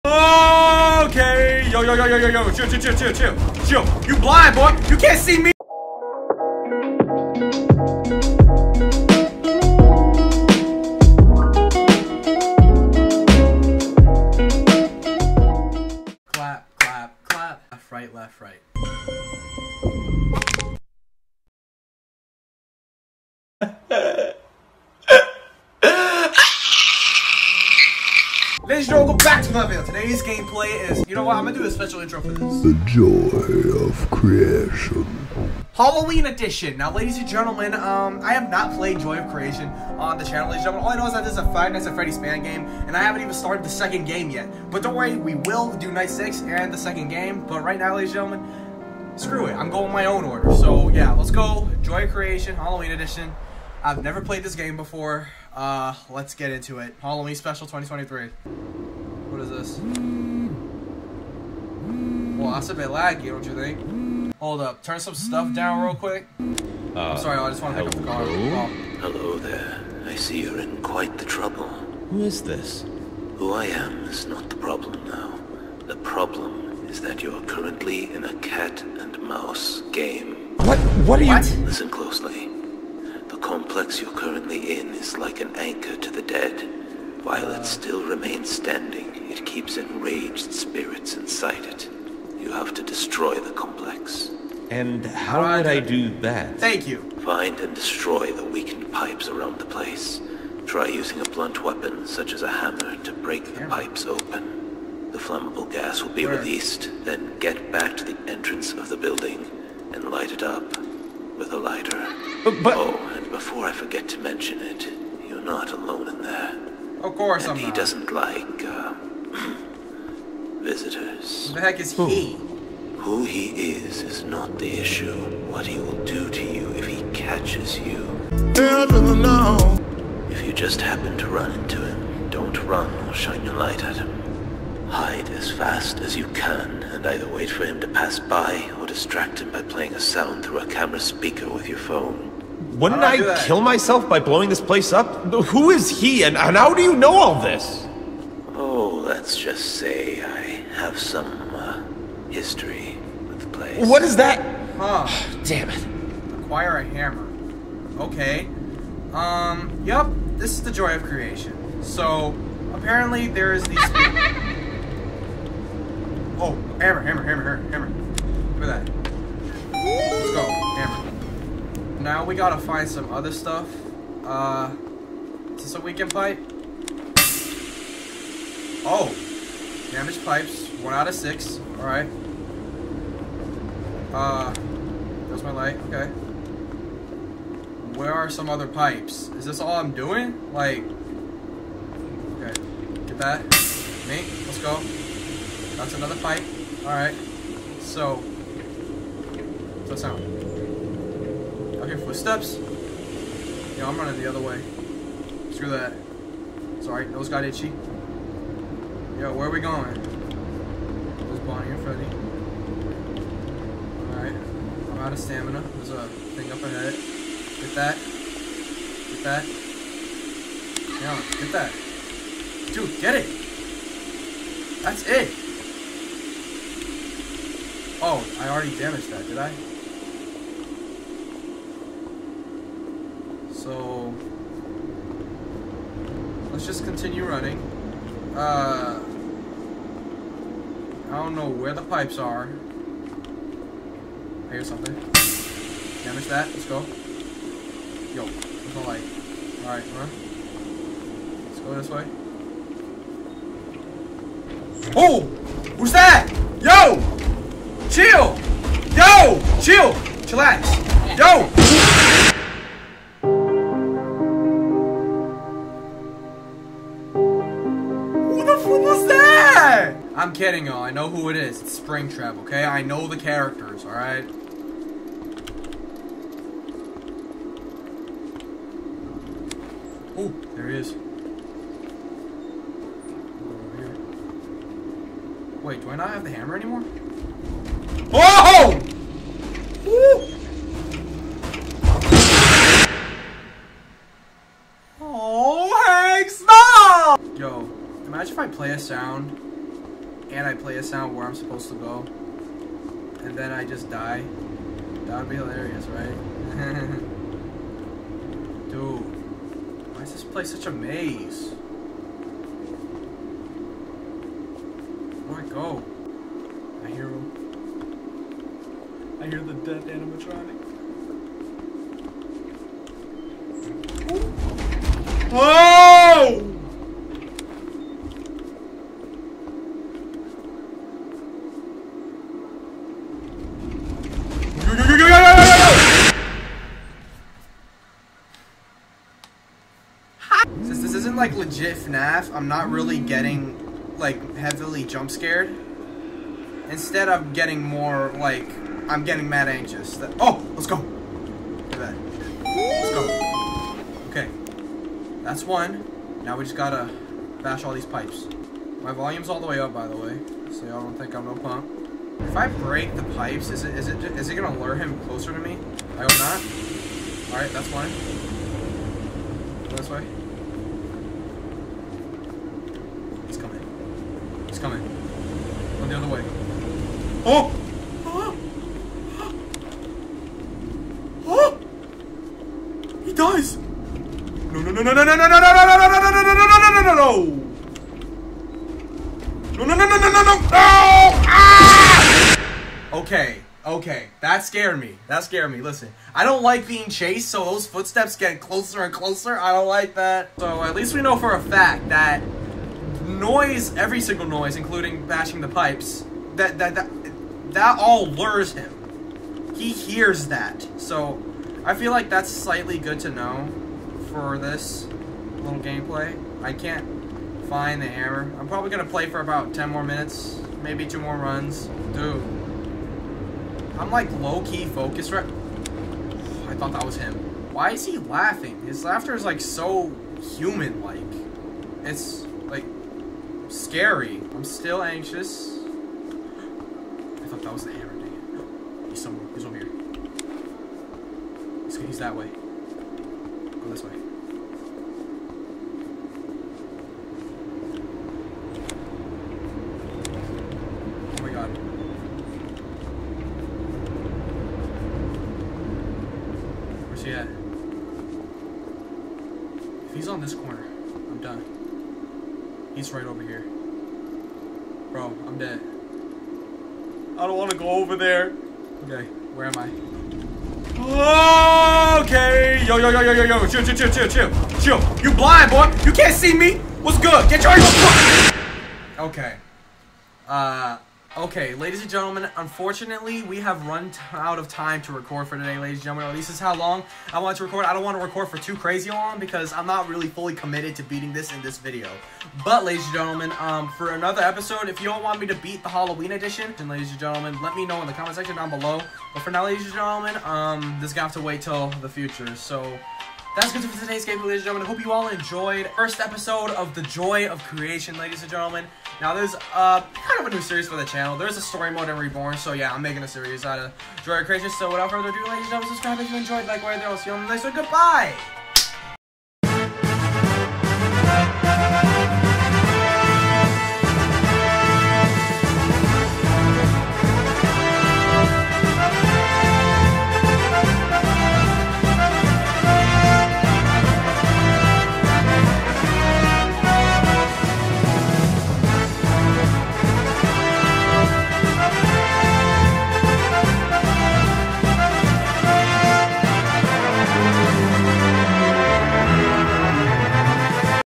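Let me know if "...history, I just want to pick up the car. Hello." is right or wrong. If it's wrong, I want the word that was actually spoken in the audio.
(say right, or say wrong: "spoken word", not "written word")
wrong: "sorry", not "history".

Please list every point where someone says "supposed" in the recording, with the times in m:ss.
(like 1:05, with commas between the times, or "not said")
5:01.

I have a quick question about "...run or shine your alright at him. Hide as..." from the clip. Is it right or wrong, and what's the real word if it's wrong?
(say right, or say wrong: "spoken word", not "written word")
wrong: "light", not "alright".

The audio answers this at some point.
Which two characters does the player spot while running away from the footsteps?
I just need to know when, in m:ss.
3:31.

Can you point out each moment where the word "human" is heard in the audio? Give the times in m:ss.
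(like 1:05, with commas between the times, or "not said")
7:10.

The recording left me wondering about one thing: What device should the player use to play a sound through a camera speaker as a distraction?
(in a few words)
phone.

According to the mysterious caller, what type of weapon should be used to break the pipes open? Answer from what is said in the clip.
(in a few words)
a blunt weapon.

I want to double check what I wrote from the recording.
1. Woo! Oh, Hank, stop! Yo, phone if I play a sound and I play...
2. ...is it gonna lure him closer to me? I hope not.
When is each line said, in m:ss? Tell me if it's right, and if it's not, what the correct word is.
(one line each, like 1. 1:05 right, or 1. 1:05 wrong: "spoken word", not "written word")
1. 4:49 wrong: "imagine", not "phone"
2. 6:04 right.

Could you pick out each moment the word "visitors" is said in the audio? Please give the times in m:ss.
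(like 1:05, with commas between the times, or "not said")
2:00.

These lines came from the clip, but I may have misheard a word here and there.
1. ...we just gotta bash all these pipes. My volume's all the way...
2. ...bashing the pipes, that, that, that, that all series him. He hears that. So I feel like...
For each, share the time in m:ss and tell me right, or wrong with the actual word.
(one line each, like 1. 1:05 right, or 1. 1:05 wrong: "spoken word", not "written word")
1. 5:56 right
2. 6:45 wrong: "lures", not "series".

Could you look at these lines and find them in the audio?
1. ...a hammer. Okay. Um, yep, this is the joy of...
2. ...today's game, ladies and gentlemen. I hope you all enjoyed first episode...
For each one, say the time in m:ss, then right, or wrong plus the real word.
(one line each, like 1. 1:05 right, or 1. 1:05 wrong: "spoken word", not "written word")
1. 2:36 right
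2. 8:23 right.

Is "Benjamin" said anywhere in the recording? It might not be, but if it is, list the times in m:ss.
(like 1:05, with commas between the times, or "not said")
not said.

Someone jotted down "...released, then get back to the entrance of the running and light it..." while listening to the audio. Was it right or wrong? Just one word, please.
wrong.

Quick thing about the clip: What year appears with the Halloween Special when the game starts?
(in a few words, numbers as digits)
2023.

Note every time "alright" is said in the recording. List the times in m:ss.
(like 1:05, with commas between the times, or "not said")
3:01, 3:16, 3:34, 4:09, 4:33.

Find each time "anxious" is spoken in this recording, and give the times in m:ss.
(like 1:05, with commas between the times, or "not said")
5:49, 7:14.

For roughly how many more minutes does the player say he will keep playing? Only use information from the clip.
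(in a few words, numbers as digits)
10.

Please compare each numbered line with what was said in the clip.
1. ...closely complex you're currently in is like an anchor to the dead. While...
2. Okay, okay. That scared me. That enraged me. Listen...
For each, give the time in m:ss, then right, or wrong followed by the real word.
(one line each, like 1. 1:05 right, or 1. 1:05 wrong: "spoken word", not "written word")
1. 1:21 right
2. 6:32 wrong: "scared", not "enraged".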